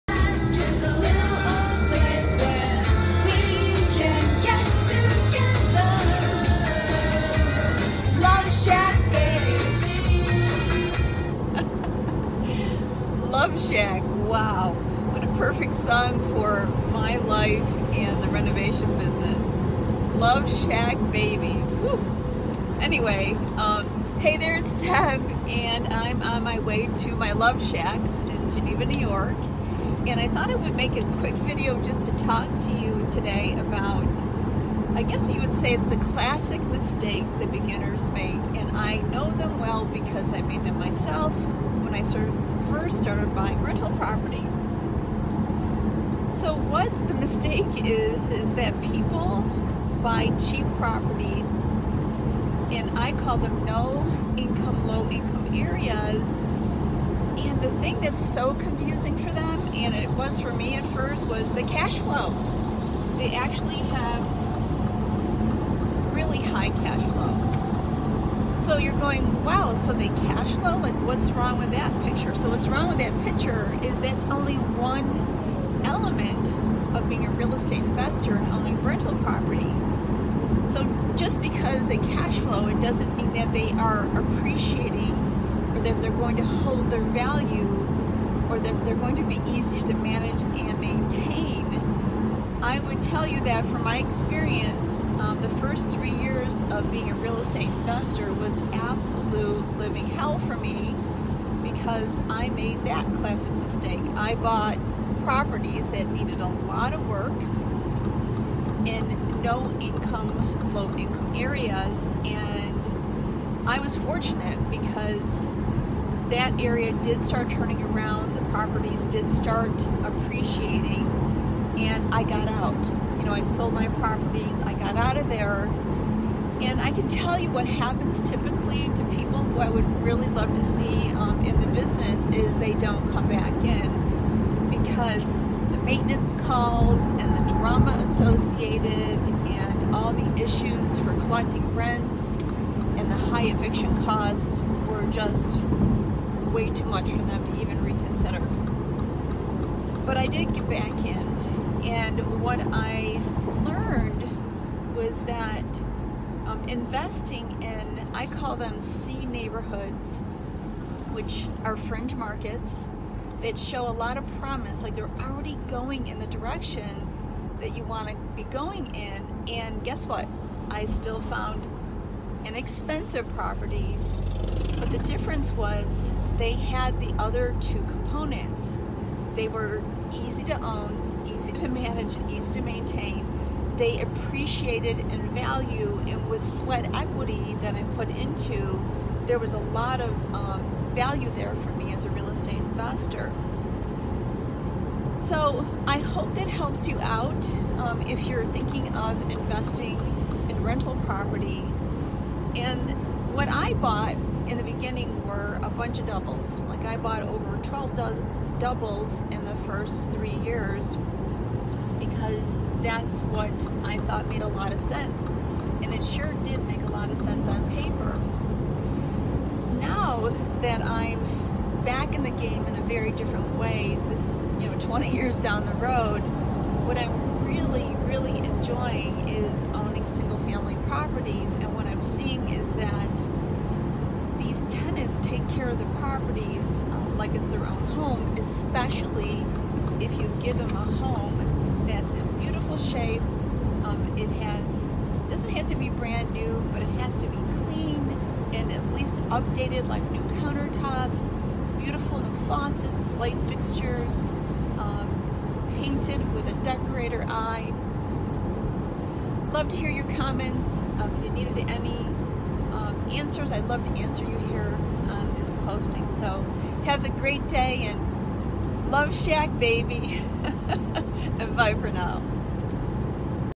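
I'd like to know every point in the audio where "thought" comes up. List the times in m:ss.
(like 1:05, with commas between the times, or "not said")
0:30, 3:33.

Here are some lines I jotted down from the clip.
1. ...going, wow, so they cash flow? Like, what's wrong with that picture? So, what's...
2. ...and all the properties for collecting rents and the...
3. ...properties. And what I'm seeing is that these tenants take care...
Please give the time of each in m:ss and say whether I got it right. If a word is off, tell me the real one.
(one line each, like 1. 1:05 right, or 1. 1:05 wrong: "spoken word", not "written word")
1. 1:08 right
2. 2:19 wrong: "issues", not "properties"
3. 3:50 right.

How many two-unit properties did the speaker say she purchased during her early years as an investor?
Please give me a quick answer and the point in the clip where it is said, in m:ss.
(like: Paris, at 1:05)
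Over 12, at 3:27.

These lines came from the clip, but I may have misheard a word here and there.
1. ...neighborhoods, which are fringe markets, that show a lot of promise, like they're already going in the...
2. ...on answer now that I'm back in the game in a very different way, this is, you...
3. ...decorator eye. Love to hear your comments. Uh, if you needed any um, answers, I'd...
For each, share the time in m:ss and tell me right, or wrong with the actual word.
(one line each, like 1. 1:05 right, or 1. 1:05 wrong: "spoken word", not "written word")
1. 2:39 right
2. 3:37 wrong: "paper", not "answer"
3. 4:16 right.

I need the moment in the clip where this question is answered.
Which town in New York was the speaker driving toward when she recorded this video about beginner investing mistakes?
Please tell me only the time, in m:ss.
0:28.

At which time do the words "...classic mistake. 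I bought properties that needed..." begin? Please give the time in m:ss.
1:43.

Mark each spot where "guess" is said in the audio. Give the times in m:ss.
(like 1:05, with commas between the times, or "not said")
0:35, 2:49.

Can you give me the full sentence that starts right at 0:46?
So what the mistake is, is that people buy cheap property and I call them no income, low income areas.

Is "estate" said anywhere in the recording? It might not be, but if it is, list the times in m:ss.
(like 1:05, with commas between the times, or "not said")
1:17, 1:37, 3:12.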